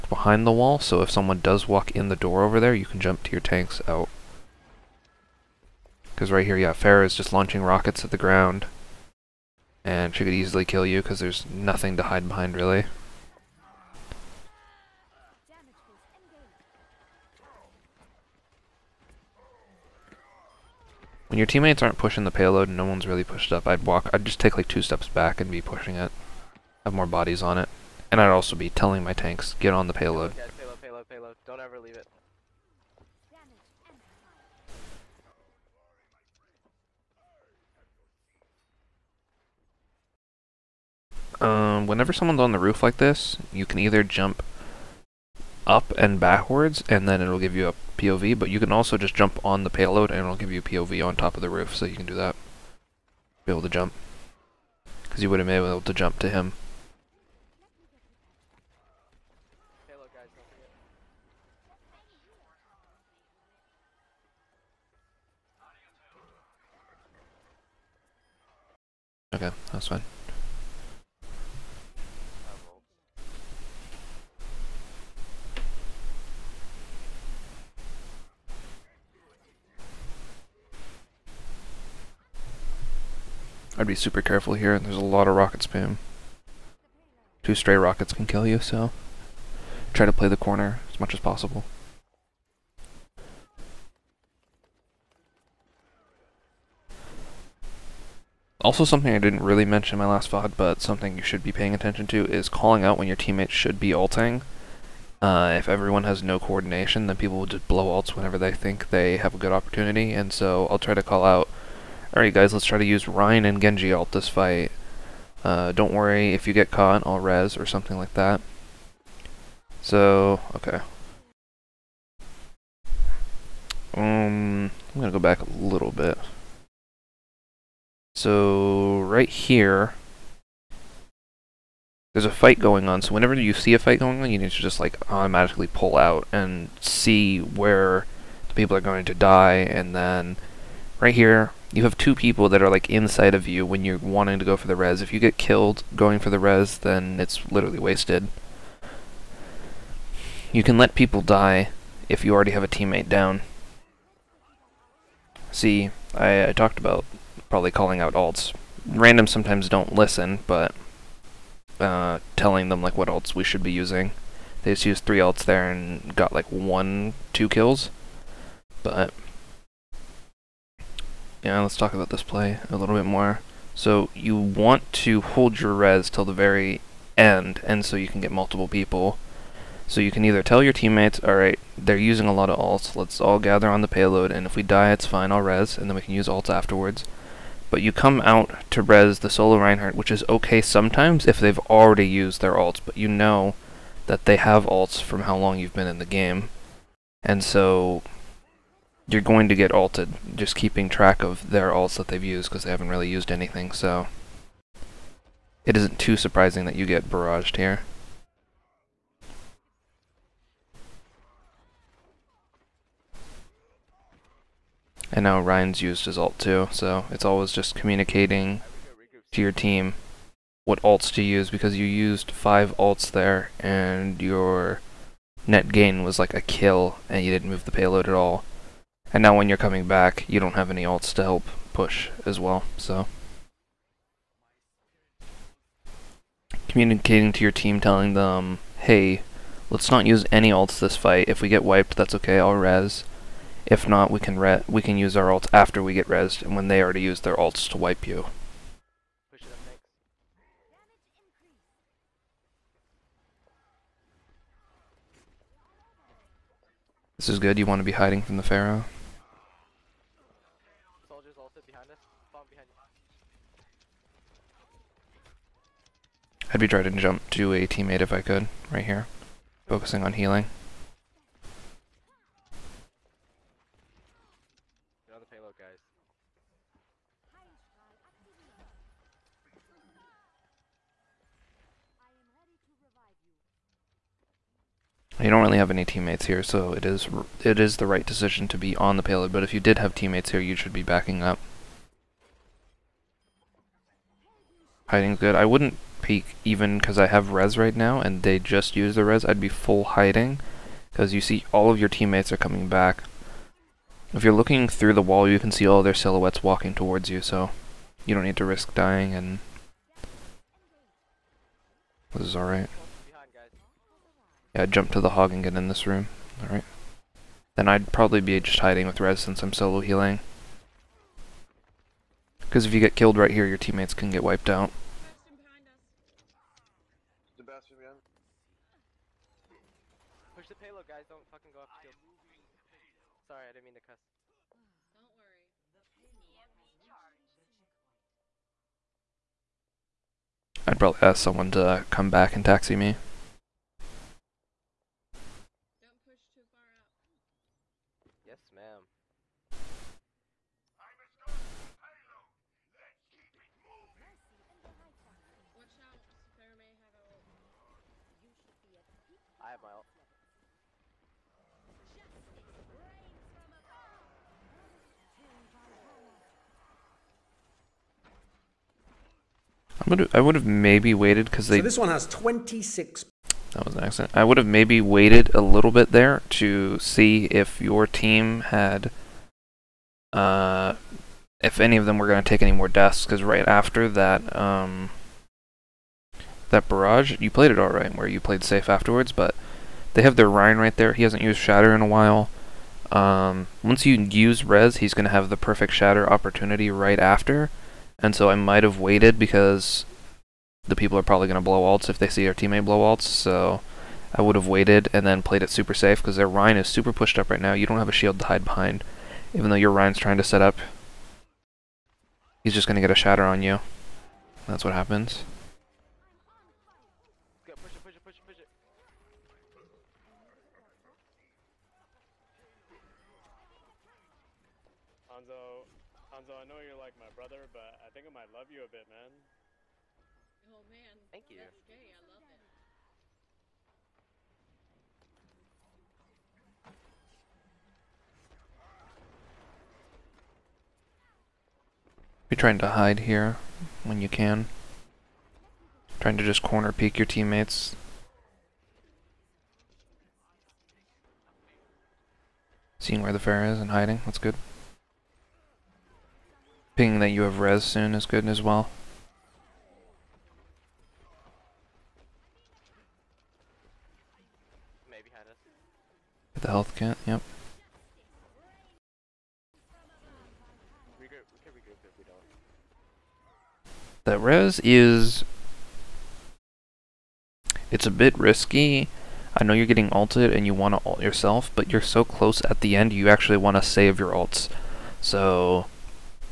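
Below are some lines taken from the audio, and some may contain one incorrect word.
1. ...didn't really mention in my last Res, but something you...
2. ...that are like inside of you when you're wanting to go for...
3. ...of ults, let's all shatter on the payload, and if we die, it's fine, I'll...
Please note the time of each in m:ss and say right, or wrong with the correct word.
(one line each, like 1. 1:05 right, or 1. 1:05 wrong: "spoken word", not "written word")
1. 1:39 wrong: "VOD", not "Res"
2. 2:22 right
3. 3:02 wrong: "gather", not "shatter".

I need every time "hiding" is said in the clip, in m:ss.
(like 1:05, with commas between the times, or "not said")
4:17, 4:54, 4:59, 5:18, 7:33.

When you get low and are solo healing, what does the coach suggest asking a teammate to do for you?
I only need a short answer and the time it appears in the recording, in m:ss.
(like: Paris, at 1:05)
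taxi me, at 5:42.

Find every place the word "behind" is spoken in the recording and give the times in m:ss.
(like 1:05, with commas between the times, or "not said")
0:00, 0:12, 6:48.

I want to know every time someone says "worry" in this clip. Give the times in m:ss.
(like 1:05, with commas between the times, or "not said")
1:55, 5:35.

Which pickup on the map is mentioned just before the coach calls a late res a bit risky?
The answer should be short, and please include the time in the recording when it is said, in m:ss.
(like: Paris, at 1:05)
health kit, at 7:46.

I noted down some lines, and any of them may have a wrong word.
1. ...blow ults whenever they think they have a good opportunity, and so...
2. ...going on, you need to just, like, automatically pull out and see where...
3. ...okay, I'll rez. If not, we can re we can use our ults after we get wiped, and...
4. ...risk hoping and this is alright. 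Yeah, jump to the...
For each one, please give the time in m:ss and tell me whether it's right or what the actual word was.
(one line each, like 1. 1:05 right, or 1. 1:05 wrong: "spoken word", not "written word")
1. 1:47 right
2. 2:14 right
3. 4:02 wrong: "rezzed", not "wiped"
4. 5:08 wrong: "dying", not "hoping".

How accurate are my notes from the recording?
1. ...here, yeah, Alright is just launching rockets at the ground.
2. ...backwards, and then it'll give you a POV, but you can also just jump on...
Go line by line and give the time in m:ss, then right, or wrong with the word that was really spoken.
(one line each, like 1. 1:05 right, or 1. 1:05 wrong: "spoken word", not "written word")
1. 0:06 wrong: "Pharah", not "Alright"
2. 0:46 right.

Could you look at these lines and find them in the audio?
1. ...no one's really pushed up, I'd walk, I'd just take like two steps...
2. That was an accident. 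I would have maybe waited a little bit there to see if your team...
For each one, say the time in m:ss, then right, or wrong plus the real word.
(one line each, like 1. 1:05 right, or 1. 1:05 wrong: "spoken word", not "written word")
1. 0:22 right
2. 6:13 right.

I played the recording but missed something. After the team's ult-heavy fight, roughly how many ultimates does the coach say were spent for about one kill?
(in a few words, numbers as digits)
5.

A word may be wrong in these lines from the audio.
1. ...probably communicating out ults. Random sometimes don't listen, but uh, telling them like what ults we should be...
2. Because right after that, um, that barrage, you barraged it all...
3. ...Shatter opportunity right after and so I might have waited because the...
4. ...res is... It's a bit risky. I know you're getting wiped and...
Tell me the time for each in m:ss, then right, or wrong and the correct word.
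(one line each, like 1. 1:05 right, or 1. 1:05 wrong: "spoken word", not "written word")
1. 2:37 wrong: "calling", not "communicating"
2. 6:23 wrong: "played", not "barraged"
3. 6:35 right
4. 7:54 wrong: "ulted", not "wiped".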